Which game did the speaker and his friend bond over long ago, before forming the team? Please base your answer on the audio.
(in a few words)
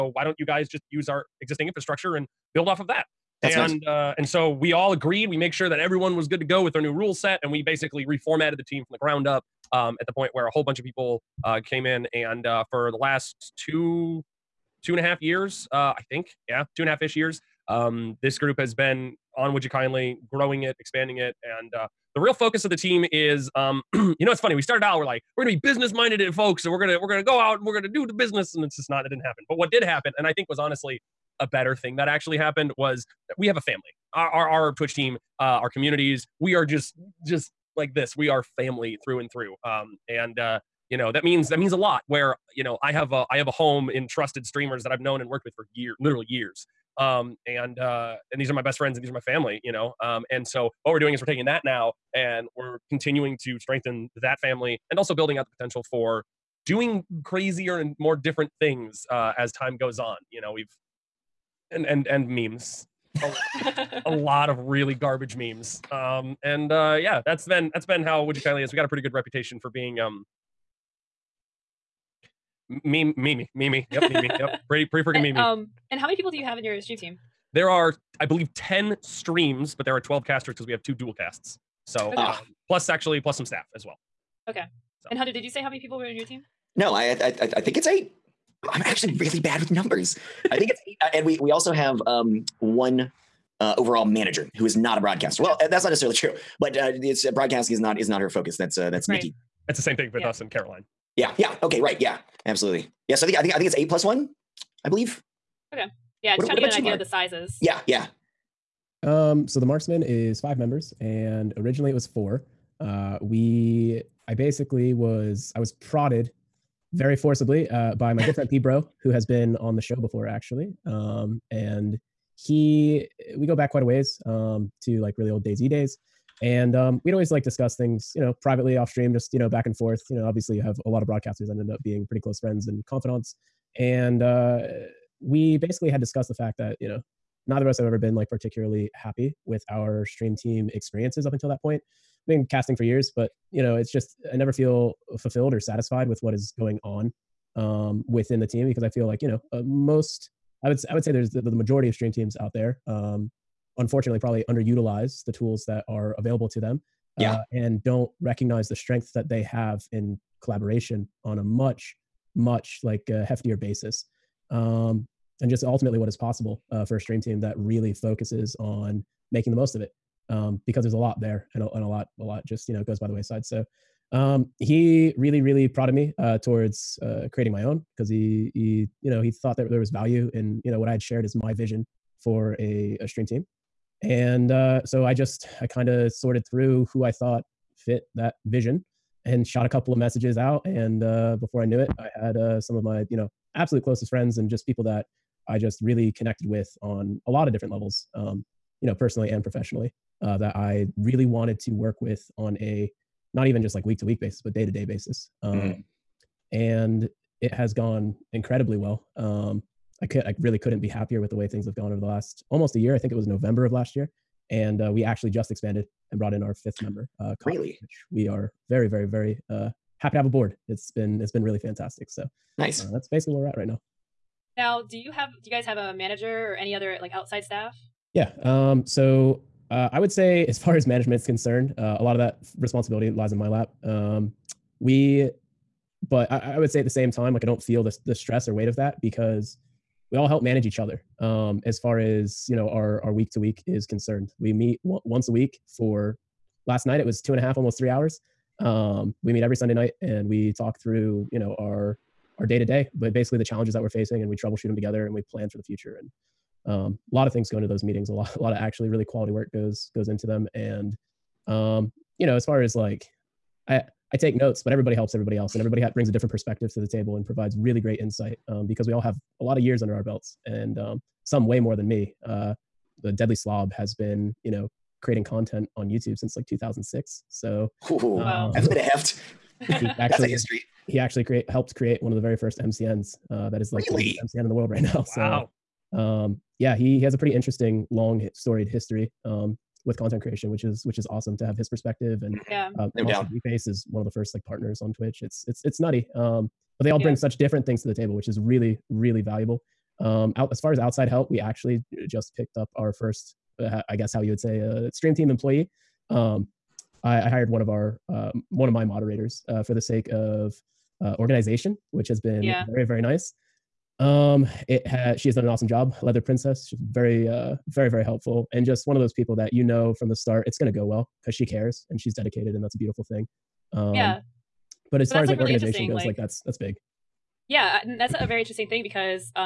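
DayZ.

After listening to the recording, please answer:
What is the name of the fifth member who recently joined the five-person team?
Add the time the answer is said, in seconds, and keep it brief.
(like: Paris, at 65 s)
Cotton, at 217 s.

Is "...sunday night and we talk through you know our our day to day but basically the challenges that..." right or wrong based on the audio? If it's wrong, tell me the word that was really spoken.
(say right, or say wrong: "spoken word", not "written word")
right.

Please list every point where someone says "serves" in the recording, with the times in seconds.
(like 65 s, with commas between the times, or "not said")
not said.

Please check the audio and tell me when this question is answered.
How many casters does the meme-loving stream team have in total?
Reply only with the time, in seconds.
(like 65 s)
79 s.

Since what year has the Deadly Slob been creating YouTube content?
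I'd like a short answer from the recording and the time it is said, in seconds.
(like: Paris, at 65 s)
2006, at 276 s.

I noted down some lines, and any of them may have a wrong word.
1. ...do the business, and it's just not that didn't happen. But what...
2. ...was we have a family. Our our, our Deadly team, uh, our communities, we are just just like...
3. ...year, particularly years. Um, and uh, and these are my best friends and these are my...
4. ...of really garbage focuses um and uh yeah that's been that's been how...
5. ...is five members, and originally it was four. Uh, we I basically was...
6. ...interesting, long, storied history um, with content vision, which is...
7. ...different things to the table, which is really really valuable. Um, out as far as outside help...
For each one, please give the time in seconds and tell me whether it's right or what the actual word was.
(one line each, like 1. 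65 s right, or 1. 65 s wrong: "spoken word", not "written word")
1. 27 s right
2. 32 s wrong: "Twitch", not "Deadly"
3. 45 s wrong: "literally", not "particularly"
4. 64 s wrong: "memes", not "focuses"
5. 110 s right
6. 287 s wrong: "creation", not "vision"
7. 297 s right.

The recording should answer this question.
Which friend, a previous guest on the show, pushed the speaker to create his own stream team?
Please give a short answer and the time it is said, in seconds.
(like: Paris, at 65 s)
P Bro, at 118 s.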